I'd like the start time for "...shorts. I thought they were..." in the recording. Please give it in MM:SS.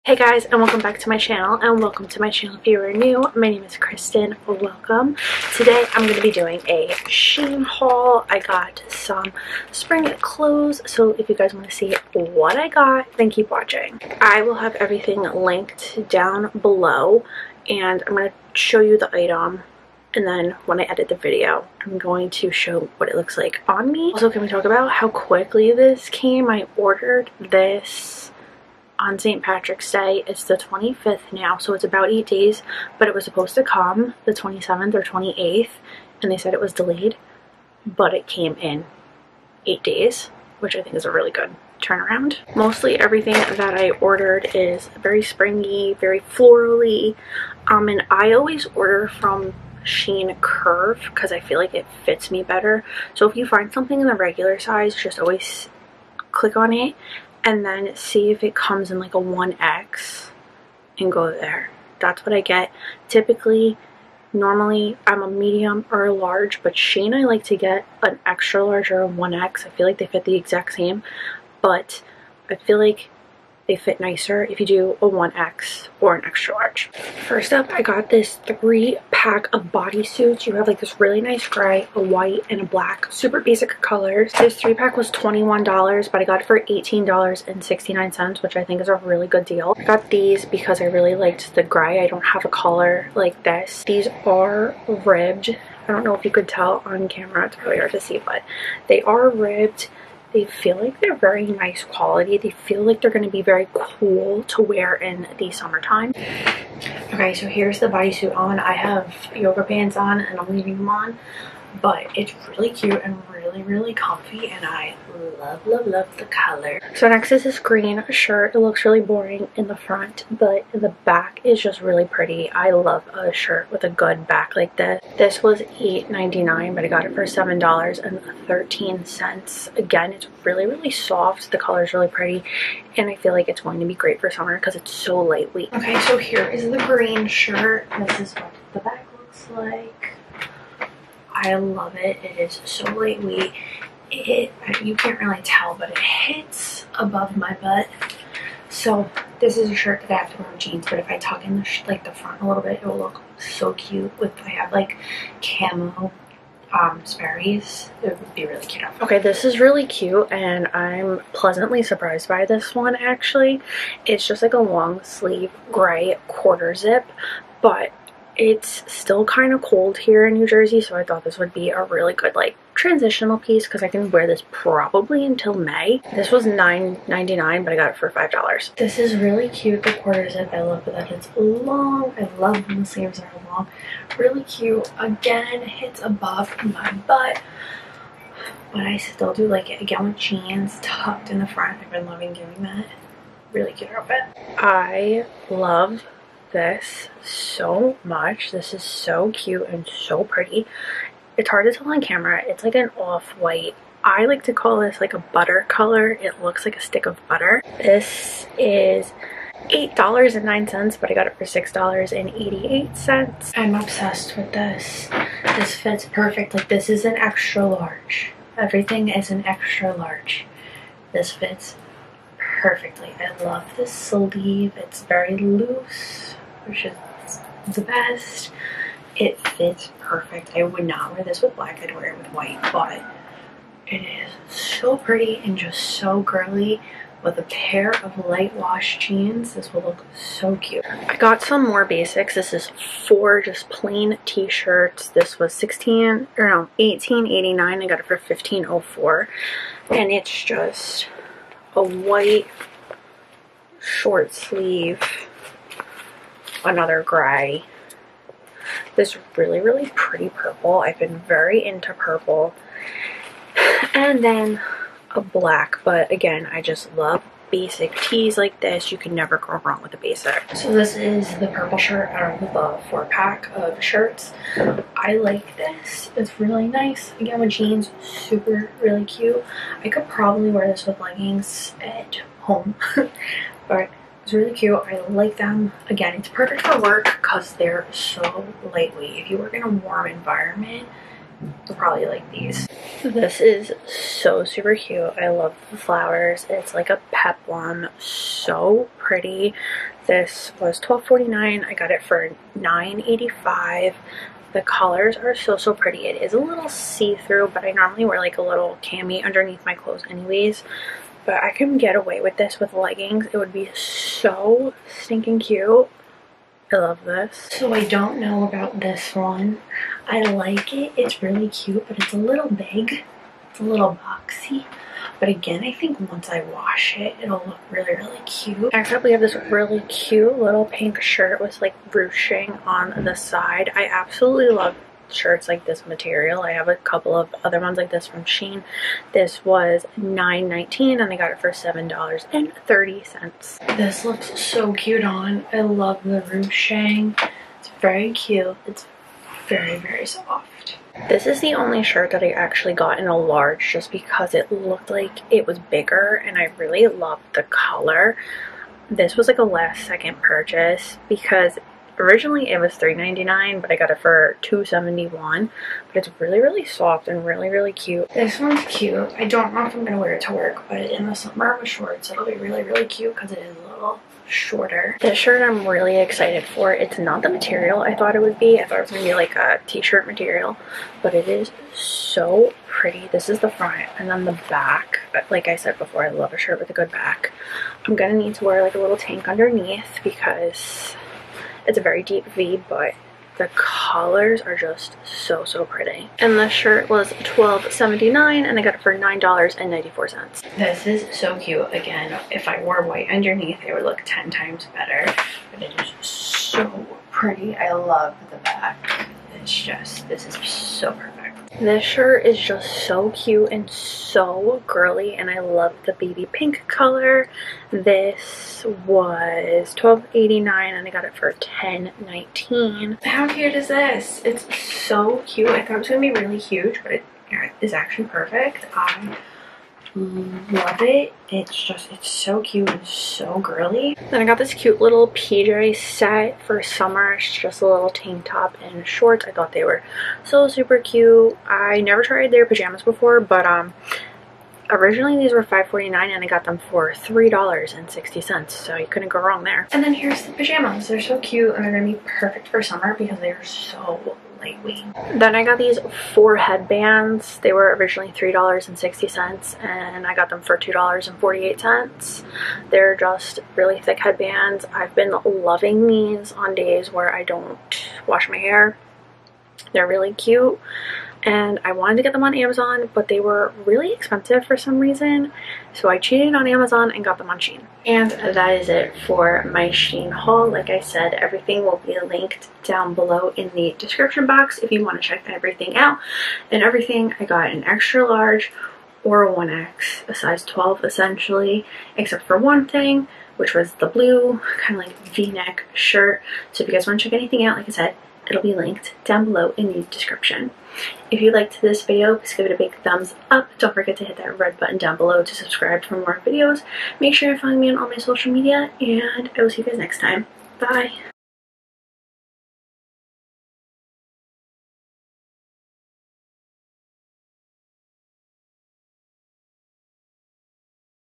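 07:18.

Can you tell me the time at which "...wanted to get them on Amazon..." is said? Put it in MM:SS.
07:51.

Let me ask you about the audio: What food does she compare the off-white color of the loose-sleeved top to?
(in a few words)
a stick of butter.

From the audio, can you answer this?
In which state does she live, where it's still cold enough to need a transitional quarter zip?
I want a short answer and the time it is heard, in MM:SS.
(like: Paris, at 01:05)
New Jersey, at 02:50.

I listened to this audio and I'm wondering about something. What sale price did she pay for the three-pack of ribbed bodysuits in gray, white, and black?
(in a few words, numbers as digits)
$18.69.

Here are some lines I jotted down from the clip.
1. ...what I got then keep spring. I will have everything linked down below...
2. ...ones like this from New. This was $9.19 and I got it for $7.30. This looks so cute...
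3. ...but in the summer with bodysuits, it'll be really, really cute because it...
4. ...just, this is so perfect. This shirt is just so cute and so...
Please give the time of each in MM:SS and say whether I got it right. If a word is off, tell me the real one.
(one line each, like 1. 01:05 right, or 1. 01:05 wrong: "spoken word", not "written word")
1. 00:12 wrong: "watching", not "spring"
2. 05:37 wrong: "Shein", not "New"
3. 06:10 wrong: "shorts", not "bodysuits"
4. 06:49 right.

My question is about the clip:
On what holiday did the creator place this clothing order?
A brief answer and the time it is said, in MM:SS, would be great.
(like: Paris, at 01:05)
St. Patrick's Day, at 00:29.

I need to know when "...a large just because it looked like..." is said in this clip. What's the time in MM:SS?
05:53.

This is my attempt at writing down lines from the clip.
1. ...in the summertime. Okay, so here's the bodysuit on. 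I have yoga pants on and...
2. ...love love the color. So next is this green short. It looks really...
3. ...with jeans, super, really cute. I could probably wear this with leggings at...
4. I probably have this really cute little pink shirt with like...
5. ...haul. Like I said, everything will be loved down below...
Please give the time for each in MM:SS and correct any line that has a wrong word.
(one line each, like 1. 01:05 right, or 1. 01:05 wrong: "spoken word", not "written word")
1. 01:44 right
2. 01:55 wrong: "shirt", not "short"
3. 04:37 right
4. 05:28 right
5. 08:00 wrong: "linked", not "loved".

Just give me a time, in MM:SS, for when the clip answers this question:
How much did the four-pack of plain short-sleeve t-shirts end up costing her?
04:08.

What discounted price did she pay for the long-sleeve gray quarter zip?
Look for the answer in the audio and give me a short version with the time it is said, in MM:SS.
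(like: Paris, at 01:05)
$5, at 02:58.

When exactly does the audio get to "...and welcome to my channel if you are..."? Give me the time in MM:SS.
00:01.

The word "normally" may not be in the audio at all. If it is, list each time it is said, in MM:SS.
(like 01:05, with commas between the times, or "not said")
01:04, 05:07.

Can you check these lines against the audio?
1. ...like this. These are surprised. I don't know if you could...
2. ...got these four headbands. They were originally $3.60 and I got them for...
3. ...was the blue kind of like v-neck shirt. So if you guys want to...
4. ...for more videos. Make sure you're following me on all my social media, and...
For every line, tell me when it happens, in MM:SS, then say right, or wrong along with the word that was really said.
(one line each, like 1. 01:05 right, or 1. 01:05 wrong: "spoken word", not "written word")
1. 01:33 wrong: "ribbed", not "surprised"
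2. 07:35 right
3. 08:13 right
4. 08:25 right.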